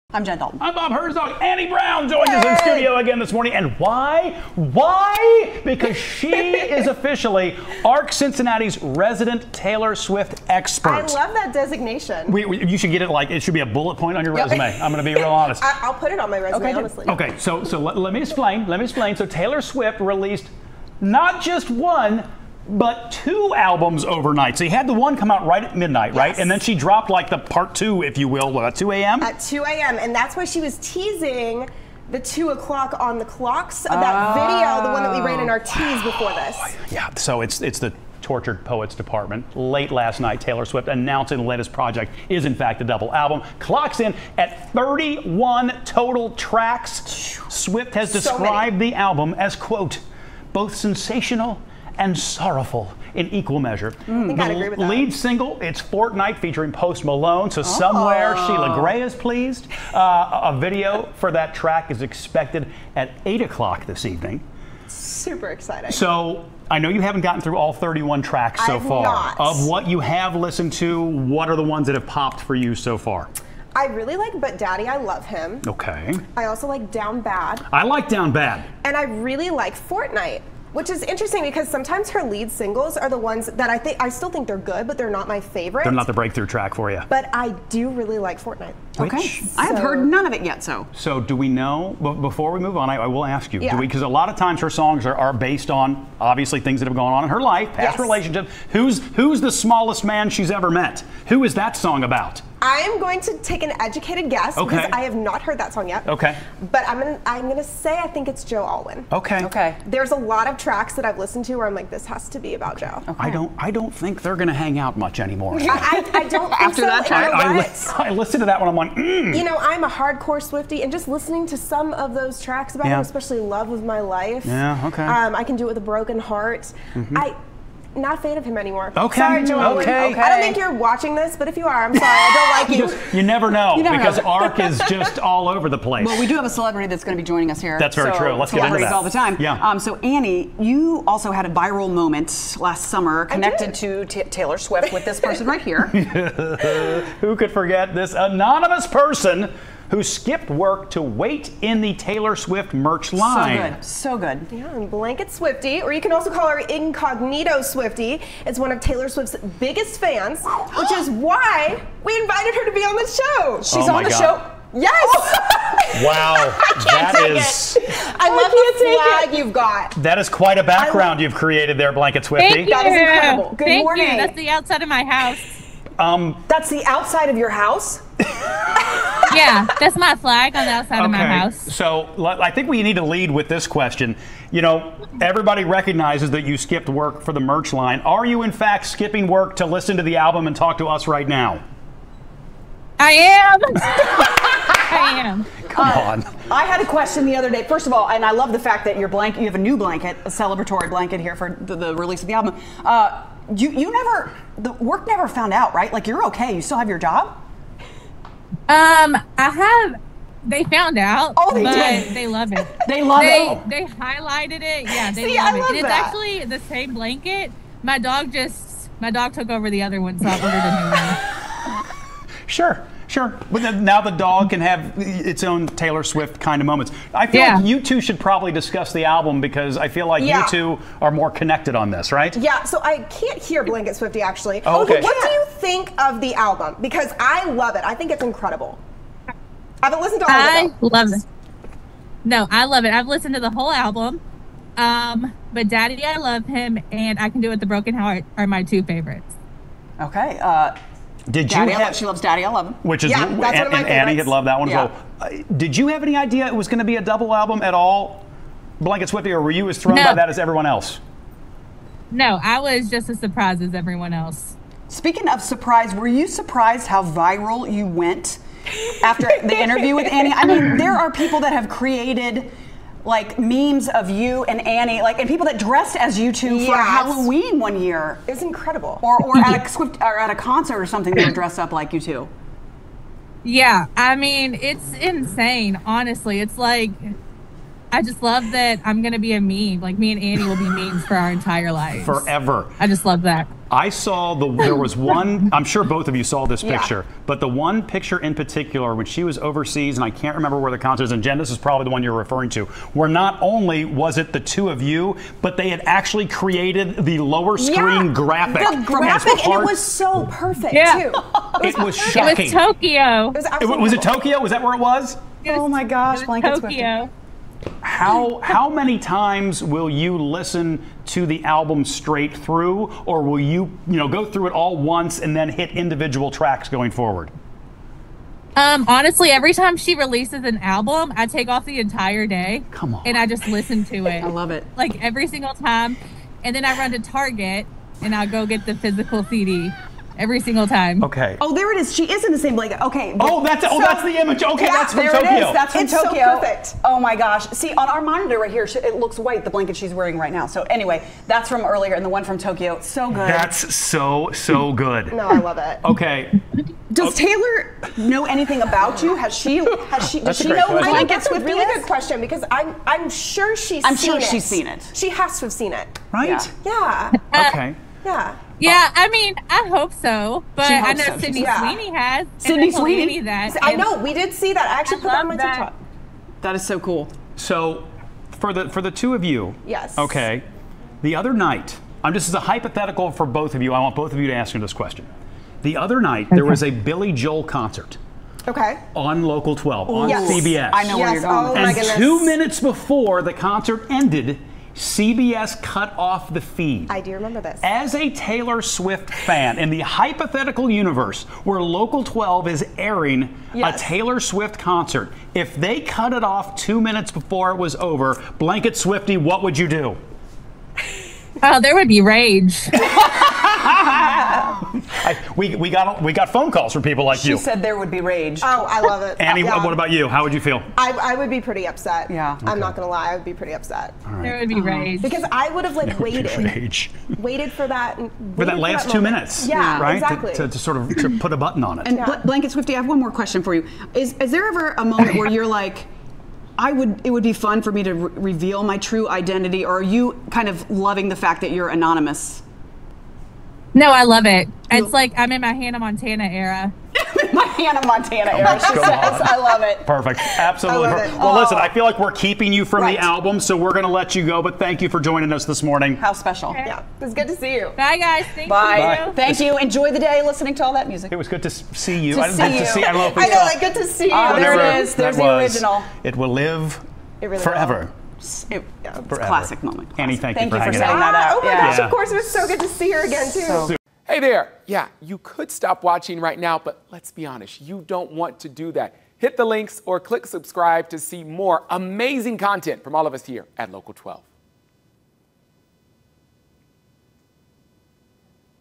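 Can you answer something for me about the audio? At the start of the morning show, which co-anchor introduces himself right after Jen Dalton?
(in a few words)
Bob Herzog.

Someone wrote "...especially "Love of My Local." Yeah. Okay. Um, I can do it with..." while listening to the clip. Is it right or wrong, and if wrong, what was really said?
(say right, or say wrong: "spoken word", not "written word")
wrong: "Life", not "Local".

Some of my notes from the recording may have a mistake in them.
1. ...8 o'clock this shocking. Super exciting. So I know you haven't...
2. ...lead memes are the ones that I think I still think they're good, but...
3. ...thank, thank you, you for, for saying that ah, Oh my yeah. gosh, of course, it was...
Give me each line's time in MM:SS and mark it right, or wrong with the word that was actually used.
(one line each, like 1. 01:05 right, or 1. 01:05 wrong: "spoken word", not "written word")
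1. 01:03 wrong: "evening", not "shocking"
2. 01:22 wrong: "singles", not "memes"
3. 07:50 right.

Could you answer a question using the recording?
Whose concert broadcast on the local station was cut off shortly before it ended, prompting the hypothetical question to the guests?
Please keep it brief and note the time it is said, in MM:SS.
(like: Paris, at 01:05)
Billy Joel, at 06:26.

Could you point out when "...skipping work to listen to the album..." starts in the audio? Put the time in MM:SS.
03:08.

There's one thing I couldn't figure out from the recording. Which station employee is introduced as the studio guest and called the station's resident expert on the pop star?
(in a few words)
Annie Brown.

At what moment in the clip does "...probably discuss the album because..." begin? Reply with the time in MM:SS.
03:48.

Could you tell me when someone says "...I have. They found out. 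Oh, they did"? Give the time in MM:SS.
03:29.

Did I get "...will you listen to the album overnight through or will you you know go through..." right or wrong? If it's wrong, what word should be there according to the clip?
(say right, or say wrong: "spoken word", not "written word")
wrong: "straight", not "overnight".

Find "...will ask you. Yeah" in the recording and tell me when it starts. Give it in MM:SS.
01:33.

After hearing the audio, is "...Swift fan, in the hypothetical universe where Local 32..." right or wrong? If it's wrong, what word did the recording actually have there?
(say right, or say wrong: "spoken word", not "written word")
wrong: "12", not "32".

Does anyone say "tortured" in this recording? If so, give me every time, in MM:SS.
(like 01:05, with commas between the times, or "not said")
00:38.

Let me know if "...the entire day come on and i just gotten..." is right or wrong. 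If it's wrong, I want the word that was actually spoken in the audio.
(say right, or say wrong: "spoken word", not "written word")
wrong: "listen", not "gotten".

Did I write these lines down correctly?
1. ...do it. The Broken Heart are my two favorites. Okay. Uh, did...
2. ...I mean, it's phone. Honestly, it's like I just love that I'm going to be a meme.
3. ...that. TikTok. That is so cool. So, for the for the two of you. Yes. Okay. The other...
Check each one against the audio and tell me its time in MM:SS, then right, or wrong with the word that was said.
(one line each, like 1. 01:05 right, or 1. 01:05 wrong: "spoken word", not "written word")
1. 04:07 right
2. 04:43 wrong: "insane", not "phone"
3. 06:15 right.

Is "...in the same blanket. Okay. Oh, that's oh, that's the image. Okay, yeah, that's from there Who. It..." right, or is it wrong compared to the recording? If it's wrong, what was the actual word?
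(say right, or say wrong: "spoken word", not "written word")
wrong: "Tokyo", not "Who".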